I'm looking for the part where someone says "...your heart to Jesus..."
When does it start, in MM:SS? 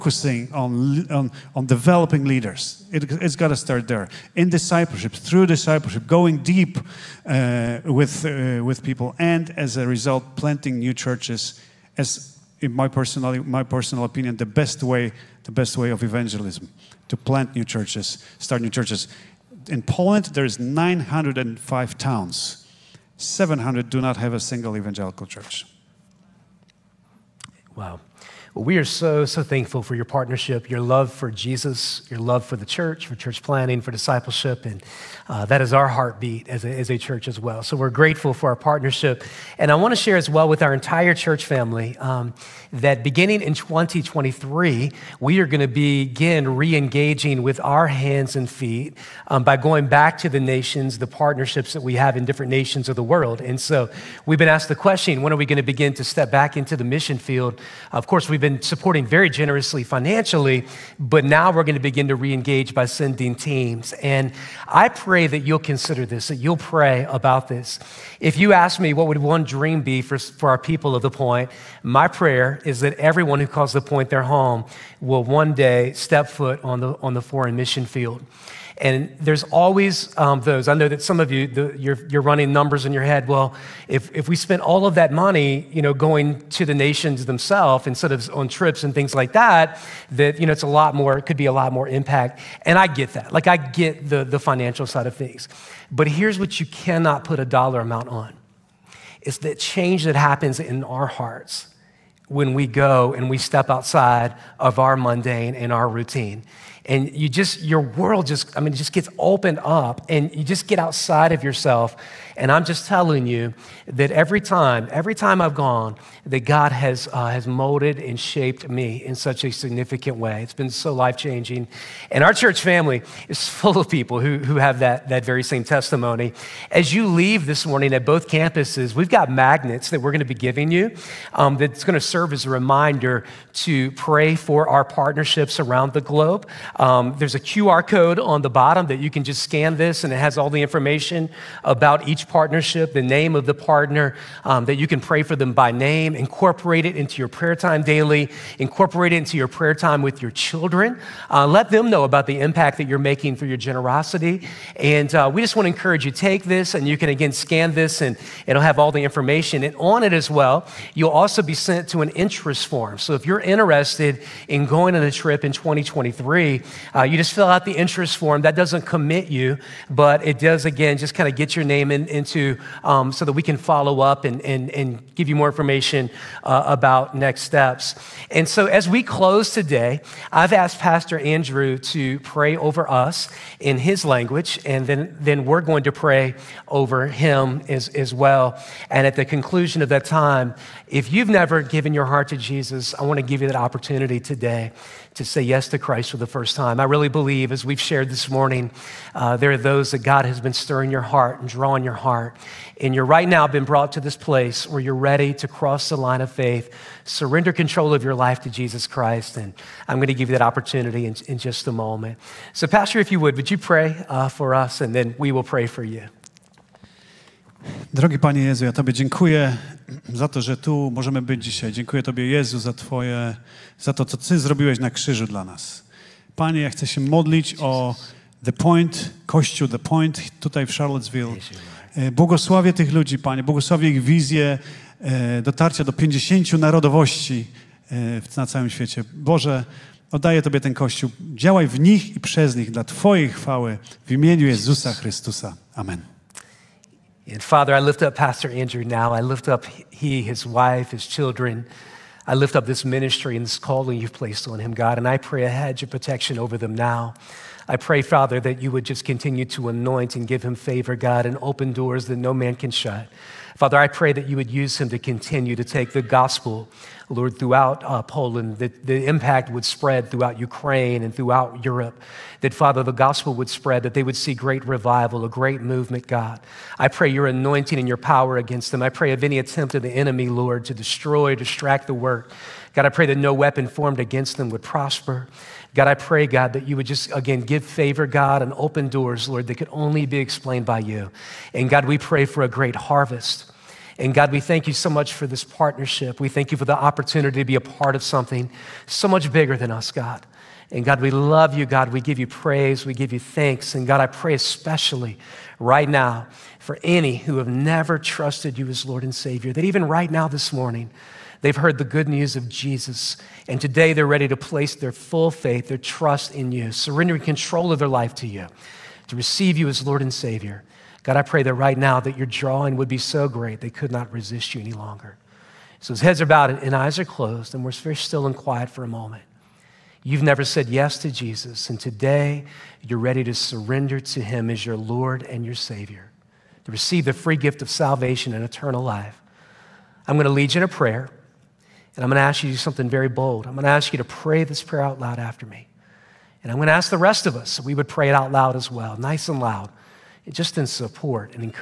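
03:11.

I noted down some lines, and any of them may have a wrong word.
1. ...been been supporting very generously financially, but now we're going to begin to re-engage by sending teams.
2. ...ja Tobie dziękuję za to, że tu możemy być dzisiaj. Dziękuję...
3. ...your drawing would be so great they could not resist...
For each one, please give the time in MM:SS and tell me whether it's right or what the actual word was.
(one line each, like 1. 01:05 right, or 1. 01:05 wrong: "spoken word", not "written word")
1. 00:58 right
2. 03:38 right
3. 05:22 right.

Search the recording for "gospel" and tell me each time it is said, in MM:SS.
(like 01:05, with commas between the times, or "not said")
04:25, 04:32.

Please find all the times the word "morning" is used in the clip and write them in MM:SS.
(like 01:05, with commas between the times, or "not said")
02:07, 03:18, 05:10.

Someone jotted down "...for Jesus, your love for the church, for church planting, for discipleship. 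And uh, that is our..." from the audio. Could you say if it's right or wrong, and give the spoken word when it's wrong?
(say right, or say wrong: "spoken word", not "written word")
right.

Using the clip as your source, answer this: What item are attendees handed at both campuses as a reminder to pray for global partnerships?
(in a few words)
Magnets.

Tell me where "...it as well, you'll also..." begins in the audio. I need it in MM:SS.
02:40.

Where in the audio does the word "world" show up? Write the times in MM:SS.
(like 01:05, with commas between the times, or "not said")
00:53, 01:47.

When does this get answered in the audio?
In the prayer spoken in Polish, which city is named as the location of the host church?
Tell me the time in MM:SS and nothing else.
03:50.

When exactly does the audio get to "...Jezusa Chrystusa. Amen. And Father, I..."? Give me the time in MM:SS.
04:04.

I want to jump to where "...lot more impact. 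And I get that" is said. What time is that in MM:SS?
01:31.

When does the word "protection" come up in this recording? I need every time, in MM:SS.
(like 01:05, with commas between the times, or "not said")
04:15.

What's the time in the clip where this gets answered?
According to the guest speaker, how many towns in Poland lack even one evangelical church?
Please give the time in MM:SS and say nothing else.
00:23.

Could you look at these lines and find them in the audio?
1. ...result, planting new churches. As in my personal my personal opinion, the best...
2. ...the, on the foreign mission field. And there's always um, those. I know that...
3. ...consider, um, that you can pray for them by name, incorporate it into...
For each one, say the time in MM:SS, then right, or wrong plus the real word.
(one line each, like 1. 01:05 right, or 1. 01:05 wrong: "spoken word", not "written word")
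1. 00:09 right
2. 01:16 right
3. 02:23 wrong: "partner", not "consider".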